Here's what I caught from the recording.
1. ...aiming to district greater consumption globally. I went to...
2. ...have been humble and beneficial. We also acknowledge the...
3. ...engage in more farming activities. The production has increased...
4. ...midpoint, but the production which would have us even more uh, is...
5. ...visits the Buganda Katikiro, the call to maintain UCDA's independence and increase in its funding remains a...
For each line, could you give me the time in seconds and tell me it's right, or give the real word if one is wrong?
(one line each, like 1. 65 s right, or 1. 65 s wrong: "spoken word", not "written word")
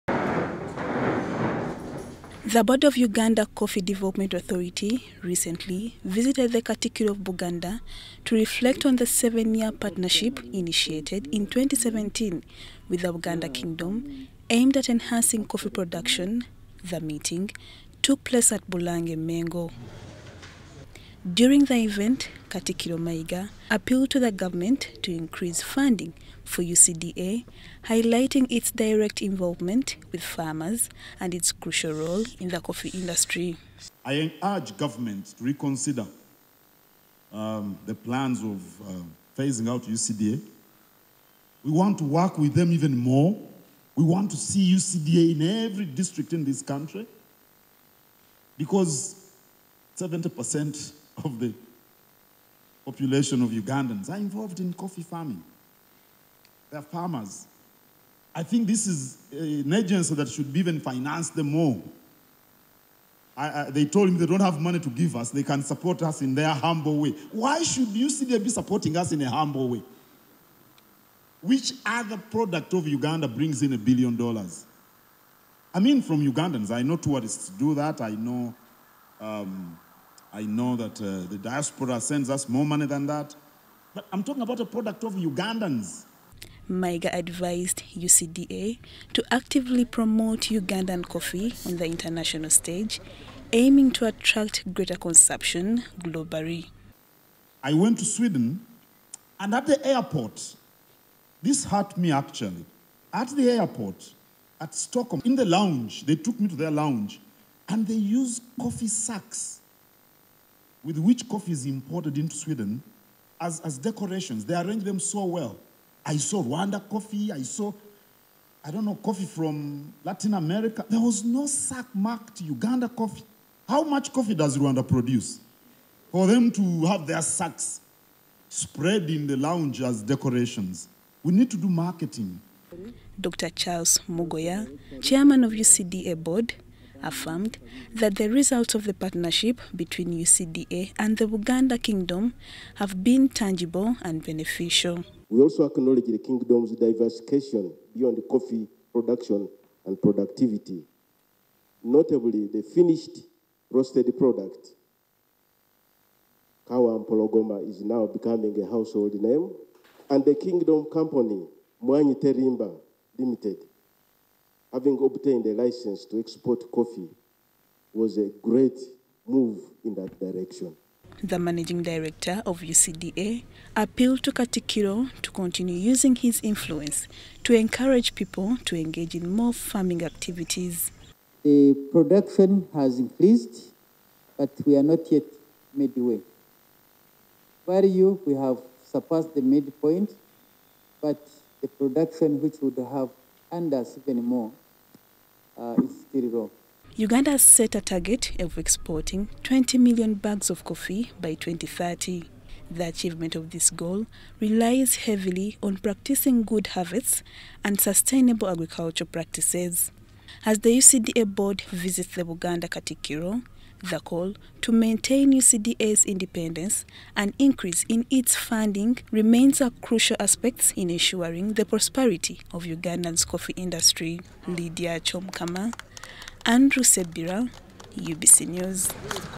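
1. 93 s wrong: "attract", not "district"
2. 142 s wrong: "tangible", not "humble"
3. 178 s right
4. 189 s right
5. 211 s right.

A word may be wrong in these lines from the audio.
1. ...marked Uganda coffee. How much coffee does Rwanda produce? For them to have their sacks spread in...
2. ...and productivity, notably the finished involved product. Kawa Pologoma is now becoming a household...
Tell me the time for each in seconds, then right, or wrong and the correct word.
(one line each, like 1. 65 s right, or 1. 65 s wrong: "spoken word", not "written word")
1. 121 s right
2. 149 s wrong: "roasted", not "involved".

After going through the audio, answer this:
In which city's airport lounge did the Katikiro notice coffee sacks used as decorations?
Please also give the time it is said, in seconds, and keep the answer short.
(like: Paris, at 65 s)
Stockholm, at 104 s.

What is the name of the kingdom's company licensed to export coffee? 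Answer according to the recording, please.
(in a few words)
Mwanyi Terimba Limited.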